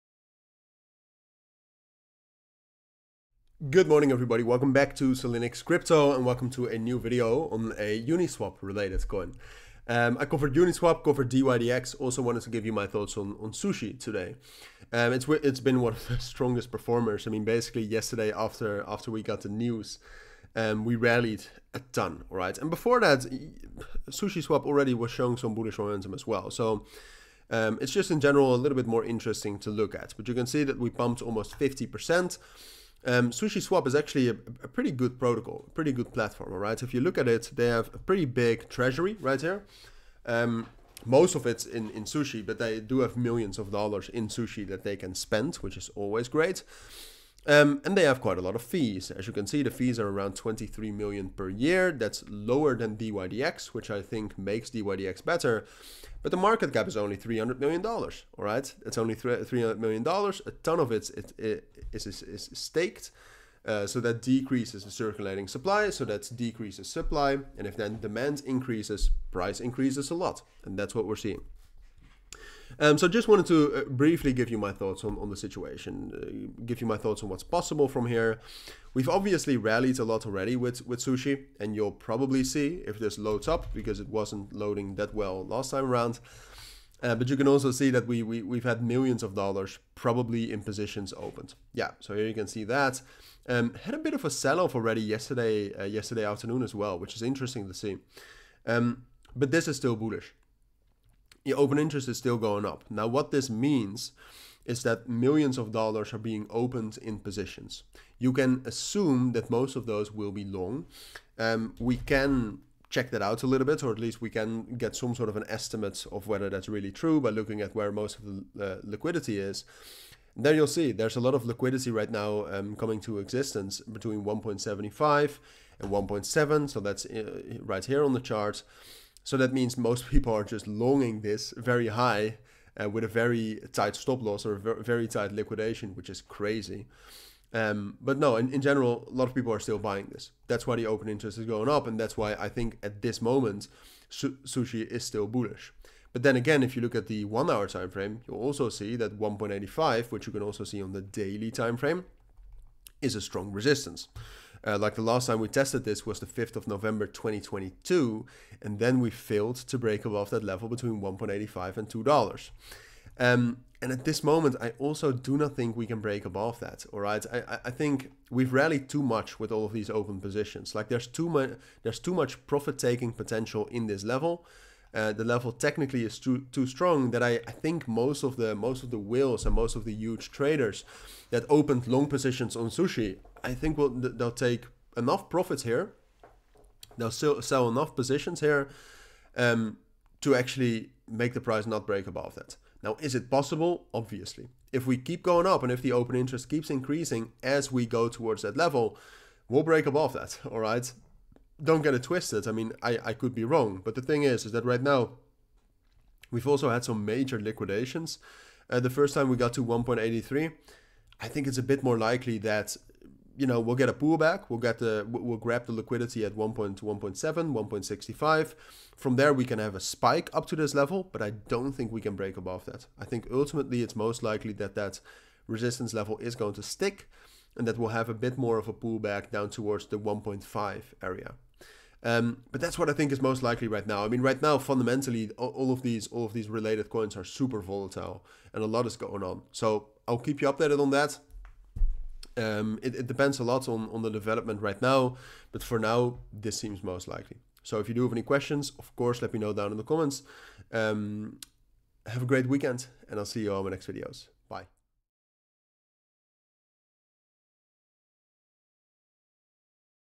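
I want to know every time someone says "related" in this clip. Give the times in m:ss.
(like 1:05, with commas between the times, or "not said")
0:08, 3:56.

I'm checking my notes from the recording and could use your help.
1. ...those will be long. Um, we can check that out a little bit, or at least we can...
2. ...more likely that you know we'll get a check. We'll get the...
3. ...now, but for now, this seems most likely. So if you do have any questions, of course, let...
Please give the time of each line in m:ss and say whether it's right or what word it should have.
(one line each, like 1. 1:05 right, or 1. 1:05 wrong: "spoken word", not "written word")
1. 1:49 right
2. 3:31 wrong: "pullback", not "check"
3. 4:04 right.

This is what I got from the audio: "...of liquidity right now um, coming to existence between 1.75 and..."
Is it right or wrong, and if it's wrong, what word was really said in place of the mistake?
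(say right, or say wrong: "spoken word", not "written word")
right.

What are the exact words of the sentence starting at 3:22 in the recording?
I mean, I, I could be wrong, but the thing is, is that right now we've also had some major liquidations.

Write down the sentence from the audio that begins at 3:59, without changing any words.
So I'll keep you updated on that.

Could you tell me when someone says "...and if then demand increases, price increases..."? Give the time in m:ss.
1:07.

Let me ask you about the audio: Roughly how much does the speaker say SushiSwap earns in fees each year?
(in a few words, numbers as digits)
23 million.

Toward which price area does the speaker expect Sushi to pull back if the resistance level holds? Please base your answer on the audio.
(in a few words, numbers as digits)
1.5.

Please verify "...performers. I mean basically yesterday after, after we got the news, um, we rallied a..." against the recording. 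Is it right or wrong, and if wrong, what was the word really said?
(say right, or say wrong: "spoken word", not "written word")
right.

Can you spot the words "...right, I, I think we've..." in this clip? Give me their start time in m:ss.
2:46.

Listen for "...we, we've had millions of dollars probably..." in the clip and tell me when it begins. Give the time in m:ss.
1:28.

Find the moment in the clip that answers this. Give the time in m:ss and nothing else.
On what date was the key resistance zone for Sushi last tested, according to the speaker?
2:36.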